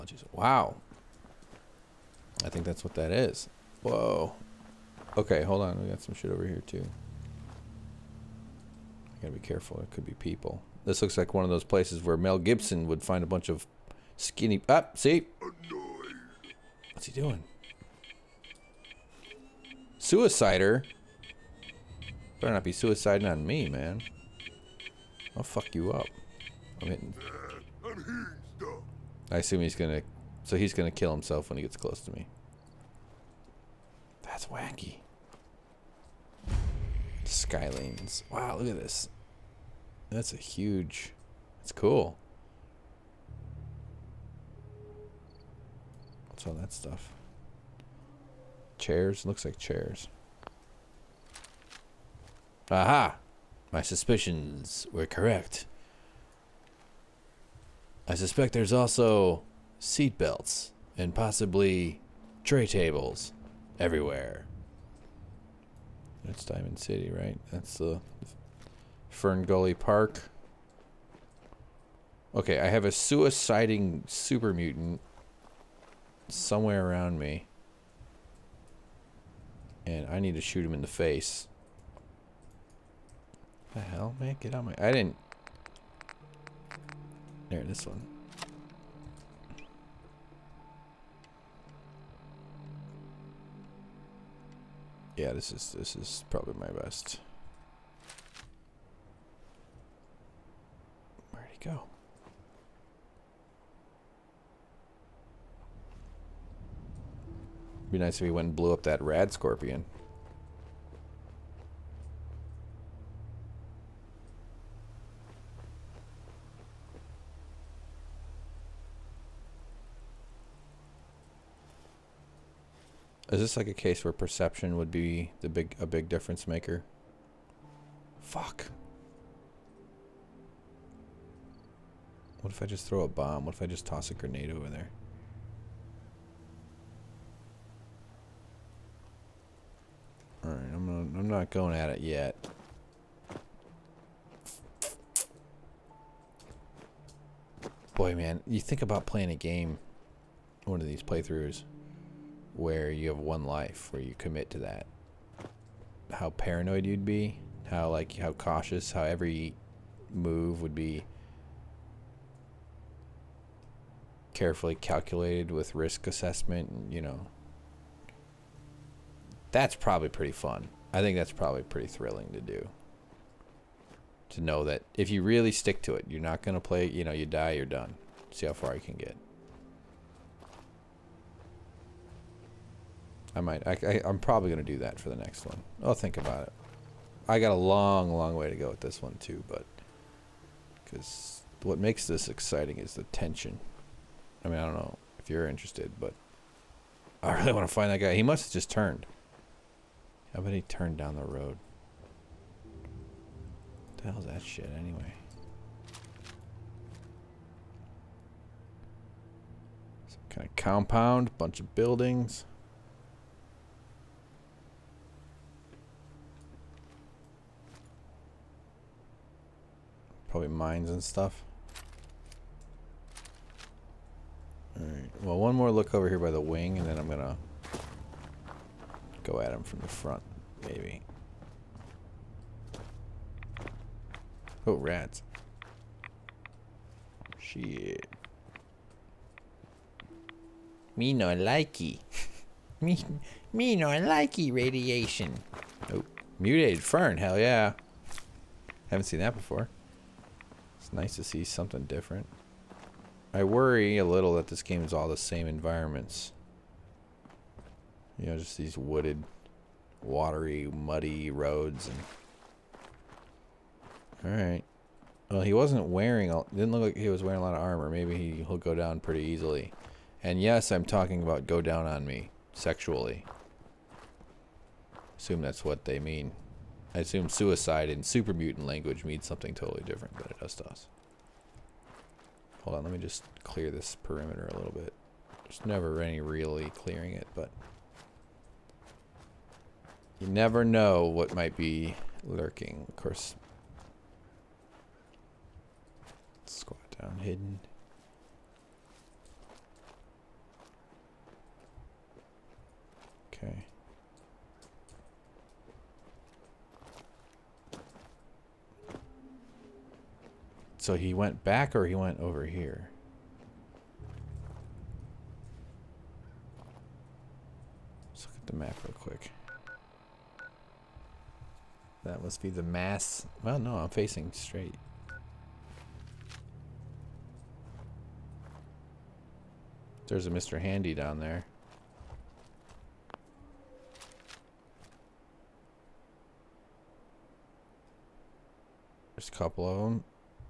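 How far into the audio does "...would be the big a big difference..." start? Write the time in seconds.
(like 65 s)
124 s.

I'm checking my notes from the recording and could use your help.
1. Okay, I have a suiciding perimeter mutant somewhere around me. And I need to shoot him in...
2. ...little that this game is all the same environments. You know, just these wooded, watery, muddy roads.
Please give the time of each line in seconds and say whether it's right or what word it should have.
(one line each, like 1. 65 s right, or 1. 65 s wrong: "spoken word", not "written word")
1. 72 s wrong: "super", not "perimeter"
2. 254 s right.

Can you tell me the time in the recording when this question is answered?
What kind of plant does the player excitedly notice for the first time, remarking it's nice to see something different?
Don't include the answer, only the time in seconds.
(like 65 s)
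246 s.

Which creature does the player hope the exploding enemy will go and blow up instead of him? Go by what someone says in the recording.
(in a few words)
rad scorpion.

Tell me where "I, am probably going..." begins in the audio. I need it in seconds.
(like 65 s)
183 s.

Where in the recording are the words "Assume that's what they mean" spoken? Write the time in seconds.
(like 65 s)
275 s.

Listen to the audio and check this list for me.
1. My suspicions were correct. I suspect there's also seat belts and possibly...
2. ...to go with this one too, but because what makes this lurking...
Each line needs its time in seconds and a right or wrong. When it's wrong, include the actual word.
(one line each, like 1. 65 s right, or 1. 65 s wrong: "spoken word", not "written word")
1. 53 s right
2. 188 s wrong: "exciting", not "lurking".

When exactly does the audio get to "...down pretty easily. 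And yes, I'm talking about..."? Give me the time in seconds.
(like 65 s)
268 s.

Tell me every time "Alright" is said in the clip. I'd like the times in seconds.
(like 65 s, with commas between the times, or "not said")
140 s, 224 s, 264 s.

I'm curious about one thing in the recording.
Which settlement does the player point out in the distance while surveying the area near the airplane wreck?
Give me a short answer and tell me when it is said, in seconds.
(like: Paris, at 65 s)
Diamond City, at 66 s.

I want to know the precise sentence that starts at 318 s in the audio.
Let's look at the map real quick.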